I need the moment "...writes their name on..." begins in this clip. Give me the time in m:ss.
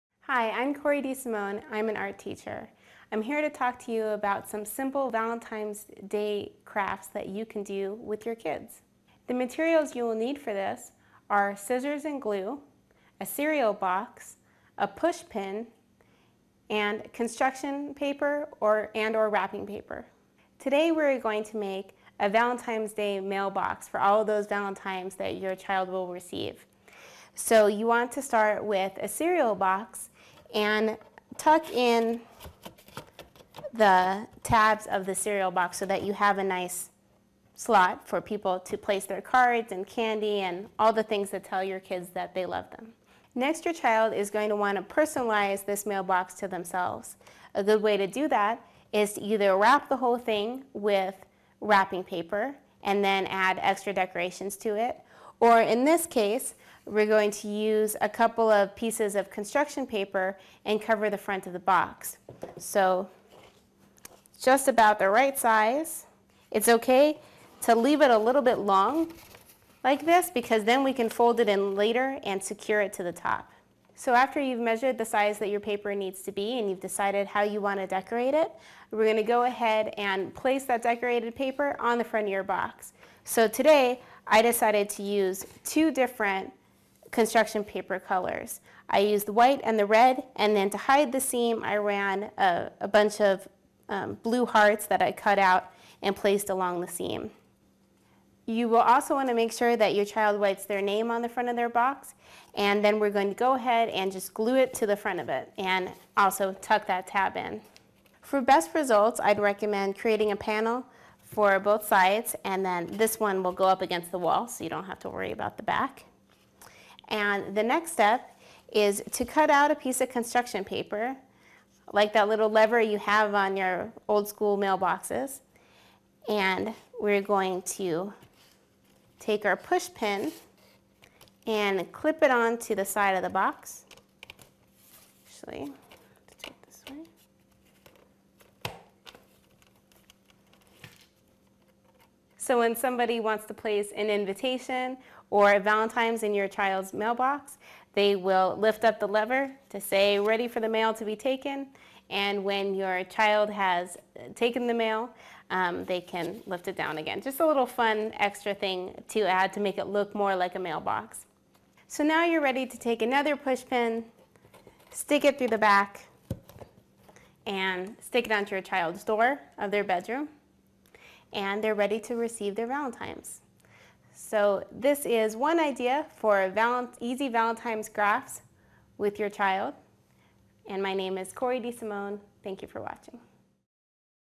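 1:40.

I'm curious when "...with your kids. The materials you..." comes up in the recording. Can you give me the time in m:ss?
0:07.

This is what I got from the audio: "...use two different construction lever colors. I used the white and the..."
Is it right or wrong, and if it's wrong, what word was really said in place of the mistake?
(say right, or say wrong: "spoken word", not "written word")
wrong: "paper", not "lever".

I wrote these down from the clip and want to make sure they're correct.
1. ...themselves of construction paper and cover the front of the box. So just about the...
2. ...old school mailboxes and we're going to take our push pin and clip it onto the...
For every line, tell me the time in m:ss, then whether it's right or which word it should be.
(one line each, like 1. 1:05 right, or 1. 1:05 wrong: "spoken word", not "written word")
1. 0:58 wrong: "pieces", not "themselves"
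2. 2:04 right.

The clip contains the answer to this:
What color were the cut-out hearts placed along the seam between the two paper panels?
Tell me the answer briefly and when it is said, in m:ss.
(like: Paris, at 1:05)
Blue, at 1:34.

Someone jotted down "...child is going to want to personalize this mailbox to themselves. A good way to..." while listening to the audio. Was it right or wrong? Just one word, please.
right.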